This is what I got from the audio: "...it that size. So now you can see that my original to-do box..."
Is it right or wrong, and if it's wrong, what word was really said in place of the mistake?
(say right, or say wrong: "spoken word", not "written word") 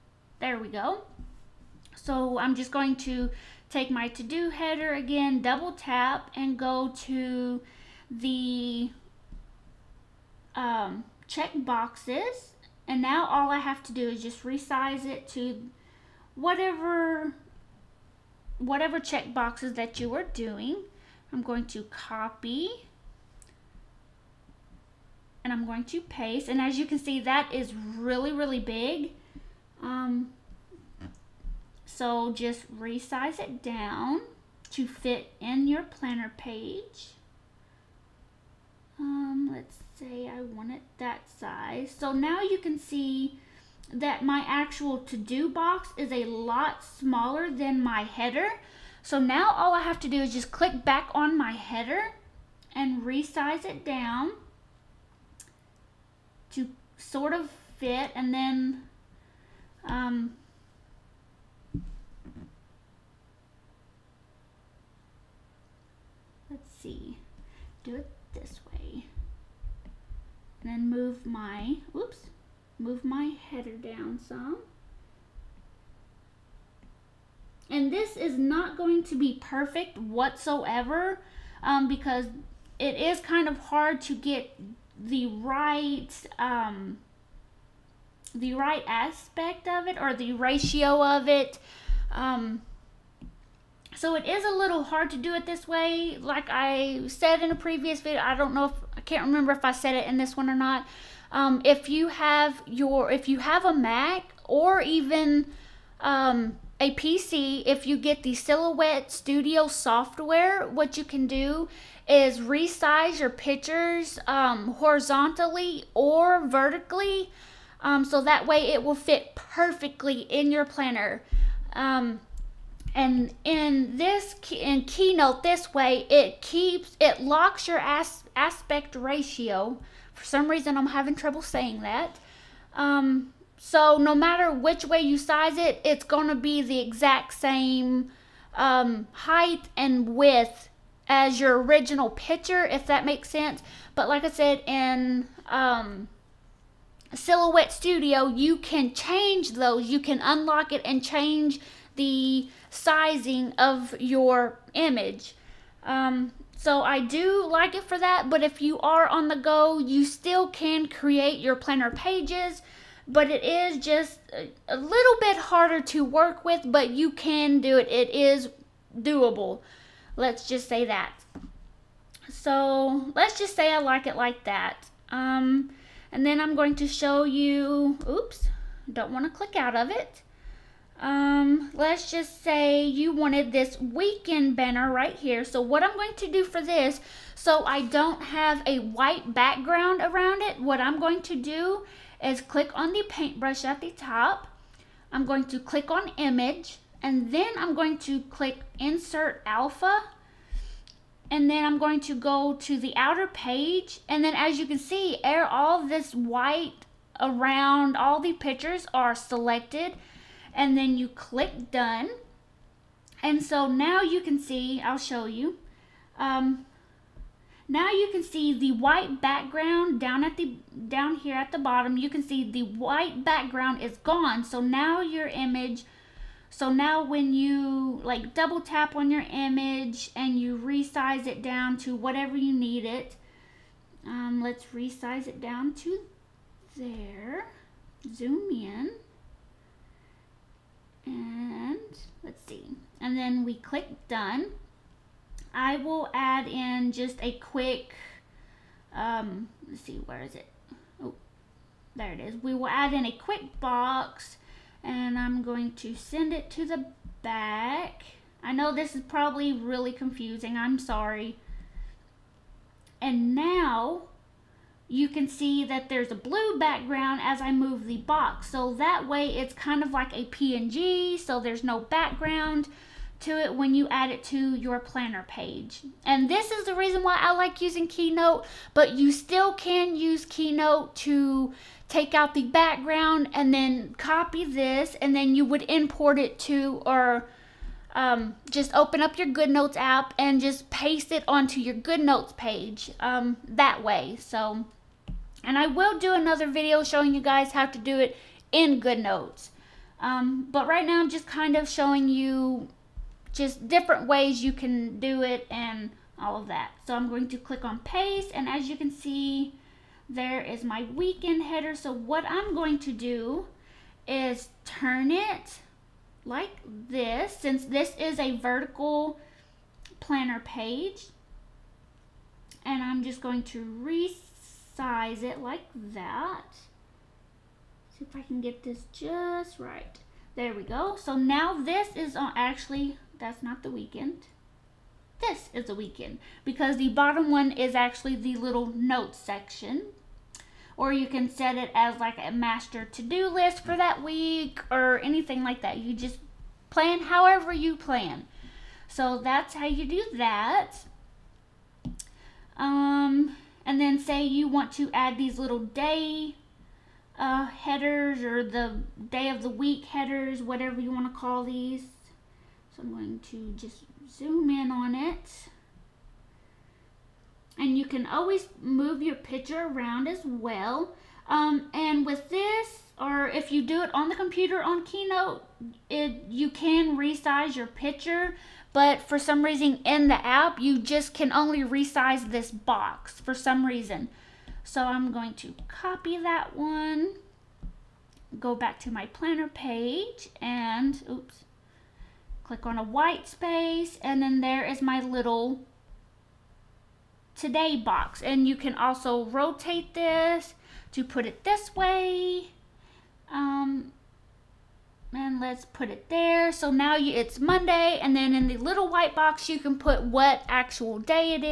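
wrong: "actual", not "original".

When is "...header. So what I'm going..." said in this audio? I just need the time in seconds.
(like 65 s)
311 s.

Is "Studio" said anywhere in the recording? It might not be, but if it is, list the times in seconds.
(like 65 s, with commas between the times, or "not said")
109 s, 147 s.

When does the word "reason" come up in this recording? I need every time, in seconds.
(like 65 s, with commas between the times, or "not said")
130 s, 276 s, 379 s, 383 s.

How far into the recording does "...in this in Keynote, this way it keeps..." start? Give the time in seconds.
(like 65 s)
123 s.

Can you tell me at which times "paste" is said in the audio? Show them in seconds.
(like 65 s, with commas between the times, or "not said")
26 s, 290 s, 307 s.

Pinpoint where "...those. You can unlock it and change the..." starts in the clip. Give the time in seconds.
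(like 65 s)
149 s.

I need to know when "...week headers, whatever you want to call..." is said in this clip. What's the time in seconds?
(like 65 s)
359 s.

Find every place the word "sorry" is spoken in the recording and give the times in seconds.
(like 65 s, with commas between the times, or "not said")
260 s.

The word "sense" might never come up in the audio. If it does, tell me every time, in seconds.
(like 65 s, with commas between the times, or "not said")
143 s.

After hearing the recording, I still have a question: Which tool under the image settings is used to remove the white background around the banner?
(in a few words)
instant alpha.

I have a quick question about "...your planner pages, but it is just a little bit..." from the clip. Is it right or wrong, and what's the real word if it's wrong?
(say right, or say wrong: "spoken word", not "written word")
right.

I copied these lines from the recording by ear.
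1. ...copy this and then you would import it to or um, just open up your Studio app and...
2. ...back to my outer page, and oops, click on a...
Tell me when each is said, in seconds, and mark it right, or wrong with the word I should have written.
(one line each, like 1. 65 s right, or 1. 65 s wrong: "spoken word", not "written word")
1. 283 s wrong: "GoodNotes", not "Studio"
2. 388 s wrong: "planner", not "outer".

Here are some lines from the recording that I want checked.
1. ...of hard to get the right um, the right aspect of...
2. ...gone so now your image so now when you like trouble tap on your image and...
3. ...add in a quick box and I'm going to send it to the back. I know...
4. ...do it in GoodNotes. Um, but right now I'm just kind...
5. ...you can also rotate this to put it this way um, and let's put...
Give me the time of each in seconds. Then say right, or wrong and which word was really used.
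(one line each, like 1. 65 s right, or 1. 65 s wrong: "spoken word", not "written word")
1. 83 s right
2. 223 s wrong: "double", not "trouble"
3. 252 s right
4. 297 s right
5. 398 s right.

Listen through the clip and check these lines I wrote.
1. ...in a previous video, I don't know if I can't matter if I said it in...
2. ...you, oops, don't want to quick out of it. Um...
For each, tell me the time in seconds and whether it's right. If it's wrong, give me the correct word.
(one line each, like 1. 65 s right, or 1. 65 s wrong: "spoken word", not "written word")
1. 97 s wrong: "remember", not "matter"
2. 177 s wrong: "click", not "quick".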